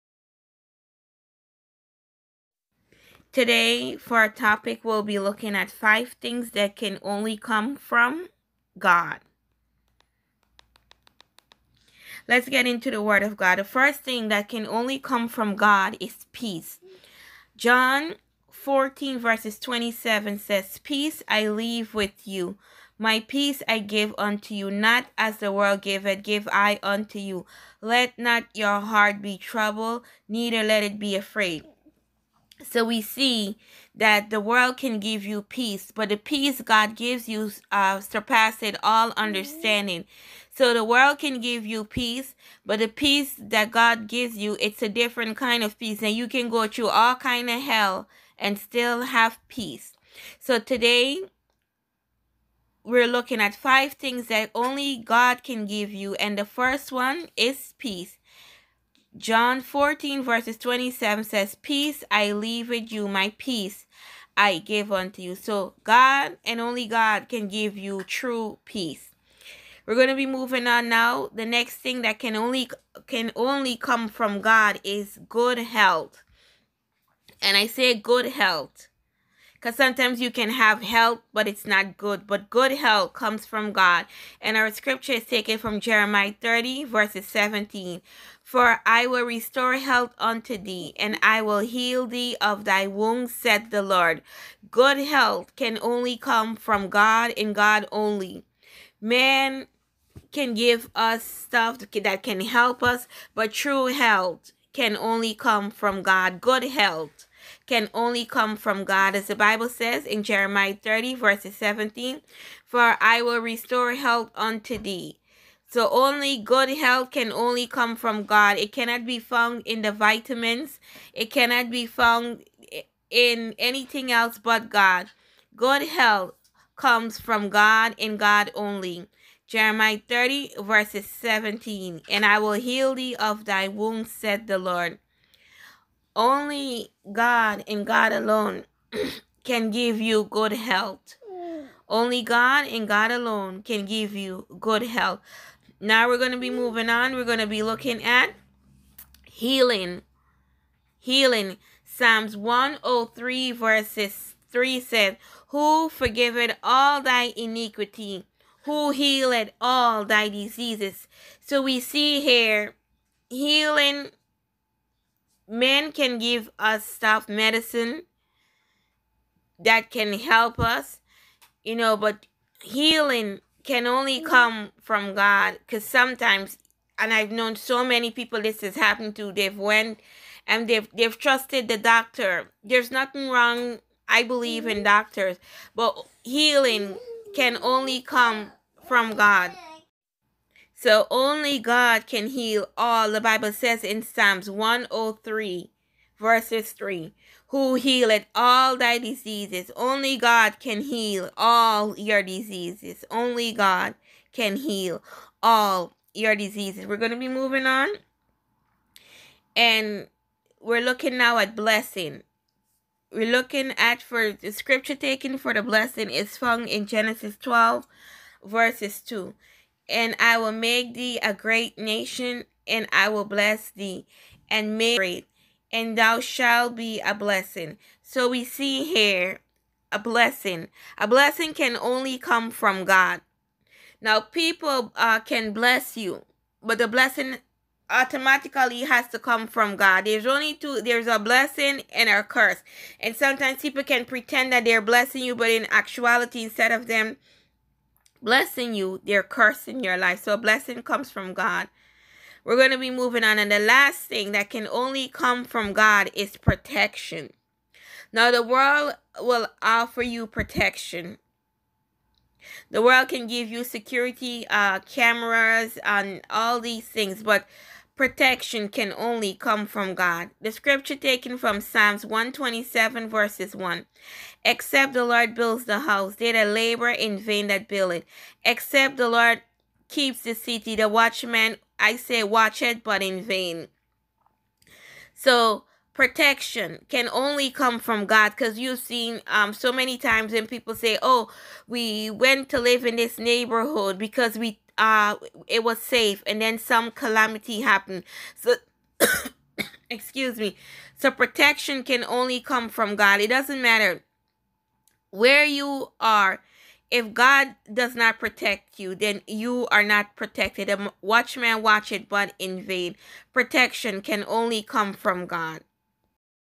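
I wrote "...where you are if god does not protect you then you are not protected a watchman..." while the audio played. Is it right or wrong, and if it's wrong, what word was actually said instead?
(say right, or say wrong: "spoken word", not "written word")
right.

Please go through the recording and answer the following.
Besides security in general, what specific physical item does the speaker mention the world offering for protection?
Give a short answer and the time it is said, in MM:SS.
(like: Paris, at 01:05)
cameras, at 04:24.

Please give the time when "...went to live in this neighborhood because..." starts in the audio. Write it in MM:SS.
04:52.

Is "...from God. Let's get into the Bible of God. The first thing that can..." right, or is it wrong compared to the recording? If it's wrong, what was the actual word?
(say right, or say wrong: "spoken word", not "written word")
wrong: "Word", not "Bible".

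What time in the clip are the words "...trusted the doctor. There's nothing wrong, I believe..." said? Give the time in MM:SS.
03:01.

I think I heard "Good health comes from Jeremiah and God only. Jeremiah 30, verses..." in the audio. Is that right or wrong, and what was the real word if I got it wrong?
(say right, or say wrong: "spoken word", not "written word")
wrong: "God", not "Jeremiah".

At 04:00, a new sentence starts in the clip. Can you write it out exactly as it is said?
There's only two there's a blessing and a curse.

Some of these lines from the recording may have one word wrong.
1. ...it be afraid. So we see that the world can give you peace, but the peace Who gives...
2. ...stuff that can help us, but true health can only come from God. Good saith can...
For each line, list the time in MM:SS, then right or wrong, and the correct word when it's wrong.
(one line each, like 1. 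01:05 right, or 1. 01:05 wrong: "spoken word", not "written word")
1. 00:30 wrong: "God", not "Who"
2. 01:41 wrong: "health", not "saith".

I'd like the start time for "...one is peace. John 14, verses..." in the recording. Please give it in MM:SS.
00:56.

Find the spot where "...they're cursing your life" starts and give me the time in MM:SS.
04:09.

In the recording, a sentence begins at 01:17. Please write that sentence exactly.
And I say good health because sometimes you can have help, but it's not good.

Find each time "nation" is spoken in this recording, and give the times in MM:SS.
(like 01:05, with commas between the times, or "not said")
03:41.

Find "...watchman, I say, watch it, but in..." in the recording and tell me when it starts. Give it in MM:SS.
04:40.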